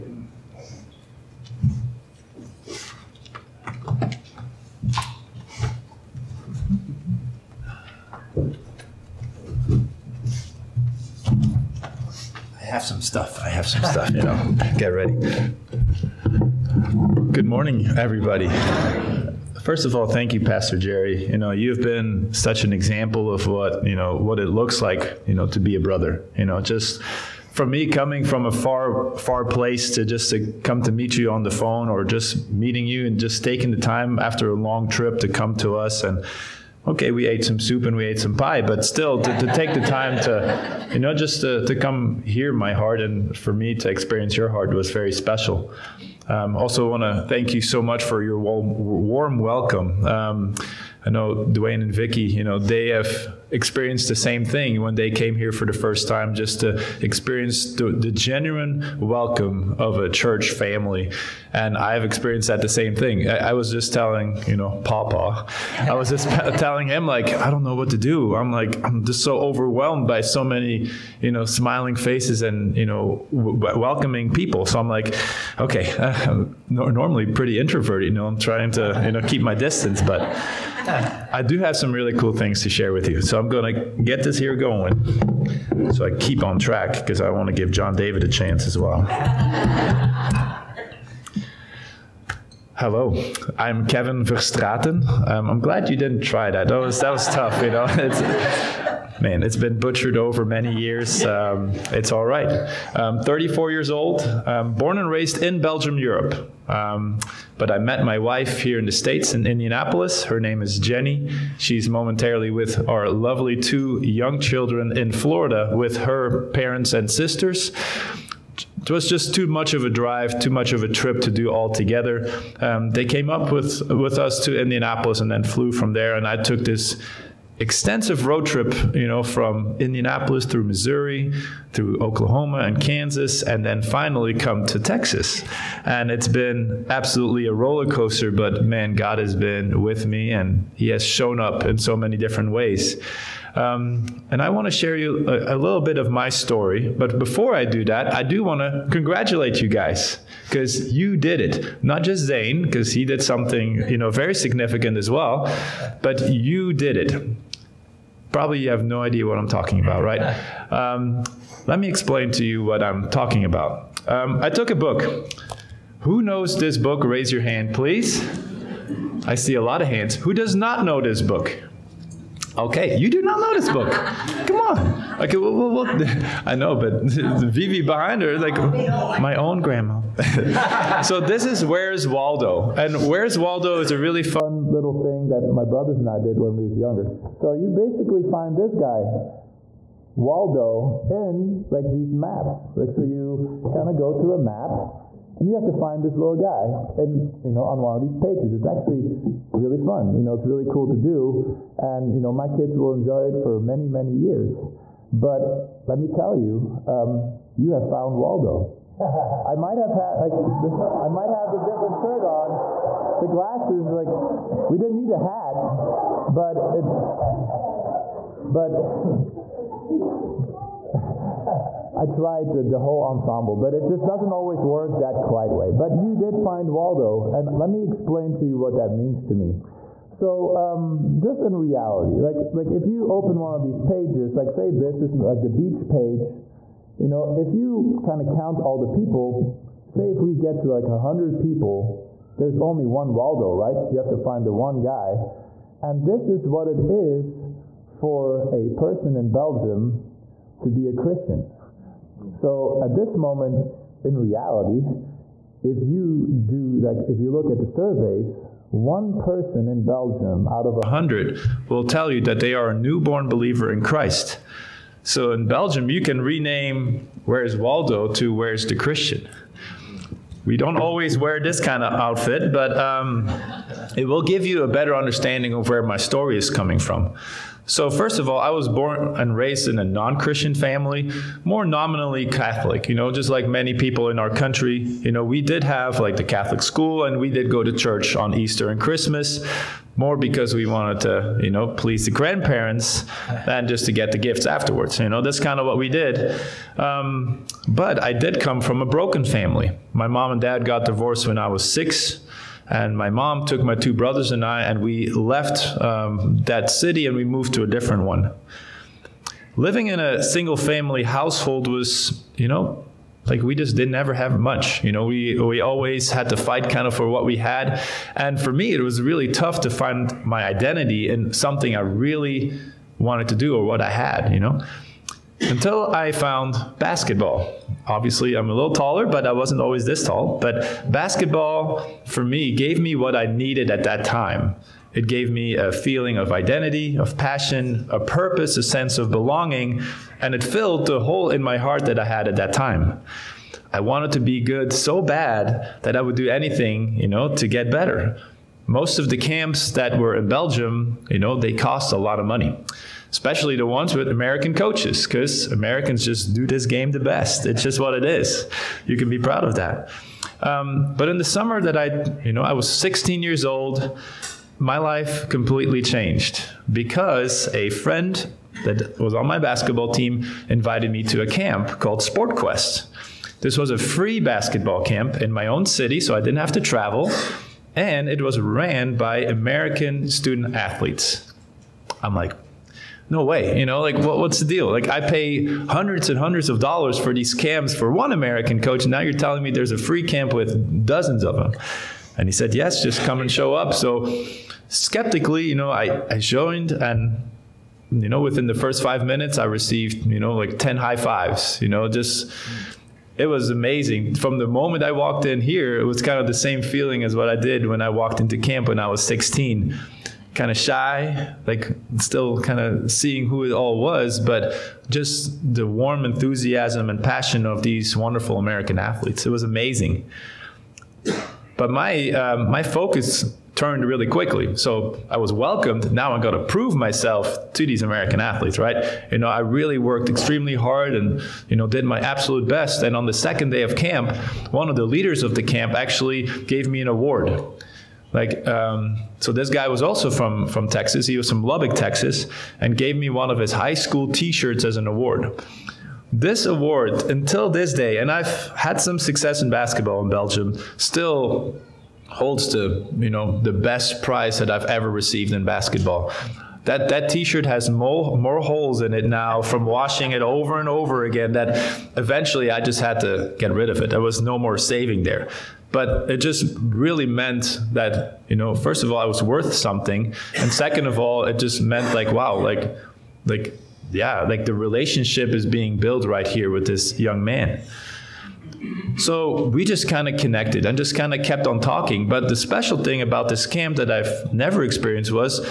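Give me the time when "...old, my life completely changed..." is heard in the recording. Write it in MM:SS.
06:03.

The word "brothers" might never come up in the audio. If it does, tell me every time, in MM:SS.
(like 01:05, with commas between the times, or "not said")
00:25, 03:05, 05:03.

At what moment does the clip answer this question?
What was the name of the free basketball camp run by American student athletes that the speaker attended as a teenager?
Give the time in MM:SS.
06:12.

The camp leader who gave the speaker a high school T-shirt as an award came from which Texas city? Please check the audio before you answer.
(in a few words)
Lubbock.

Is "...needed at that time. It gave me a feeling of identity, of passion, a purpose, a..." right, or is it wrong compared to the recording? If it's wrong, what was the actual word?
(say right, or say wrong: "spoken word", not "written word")
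right.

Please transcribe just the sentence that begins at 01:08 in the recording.
I'm like, I'm just so overwhelmed by so many, you know, smiling faces and, you know, w- welcoming people.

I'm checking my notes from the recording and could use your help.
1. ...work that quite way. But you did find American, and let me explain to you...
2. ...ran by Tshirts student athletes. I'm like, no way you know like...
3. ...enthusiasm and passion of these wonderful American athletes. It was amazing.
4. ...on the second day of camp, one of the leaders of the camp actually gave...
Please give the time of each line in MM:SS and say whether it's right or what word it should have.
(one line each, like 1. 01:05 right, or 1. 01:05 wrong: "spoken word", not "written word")
1. 03:44 wrong: "Waldo", not "American"
2. 06:18 wrong: "American", not "Tshirts"
3. 06:56 right
4. 07:12 right.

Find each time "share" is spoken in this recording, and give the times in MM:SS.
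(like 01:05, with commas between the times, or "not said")
01:22, 02:24.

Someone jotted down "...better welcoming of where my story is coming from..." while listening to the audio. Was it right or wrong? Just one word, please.
wrong.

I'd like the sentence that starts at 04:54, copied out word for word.
You know, that's kind of what we did.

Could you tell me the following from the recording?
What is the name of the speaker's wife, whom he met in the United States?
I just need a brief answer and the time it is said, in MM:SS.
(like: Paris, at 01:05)
Jenny, at 01:50.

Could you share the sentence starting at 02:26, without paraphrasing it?
But before I do that, I do want to congratulate you guys because you did it.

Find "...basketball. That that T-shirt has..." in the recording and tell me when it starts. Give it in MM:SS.
07:35.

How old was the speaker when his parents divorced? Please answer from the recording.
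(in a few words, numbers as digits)
6.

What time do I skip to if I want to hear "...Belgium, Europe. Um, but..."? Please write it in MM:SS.
01:45.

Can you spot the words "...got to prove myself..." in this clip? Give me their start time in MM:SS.
07:06.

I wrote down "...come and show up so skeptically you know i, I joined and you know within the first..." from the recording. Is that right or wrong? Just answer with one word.
right.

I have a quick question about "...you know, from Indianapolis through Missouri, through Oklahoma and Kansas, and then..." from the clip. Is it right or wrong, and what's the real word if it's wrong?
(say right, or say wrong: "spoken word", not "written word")
right.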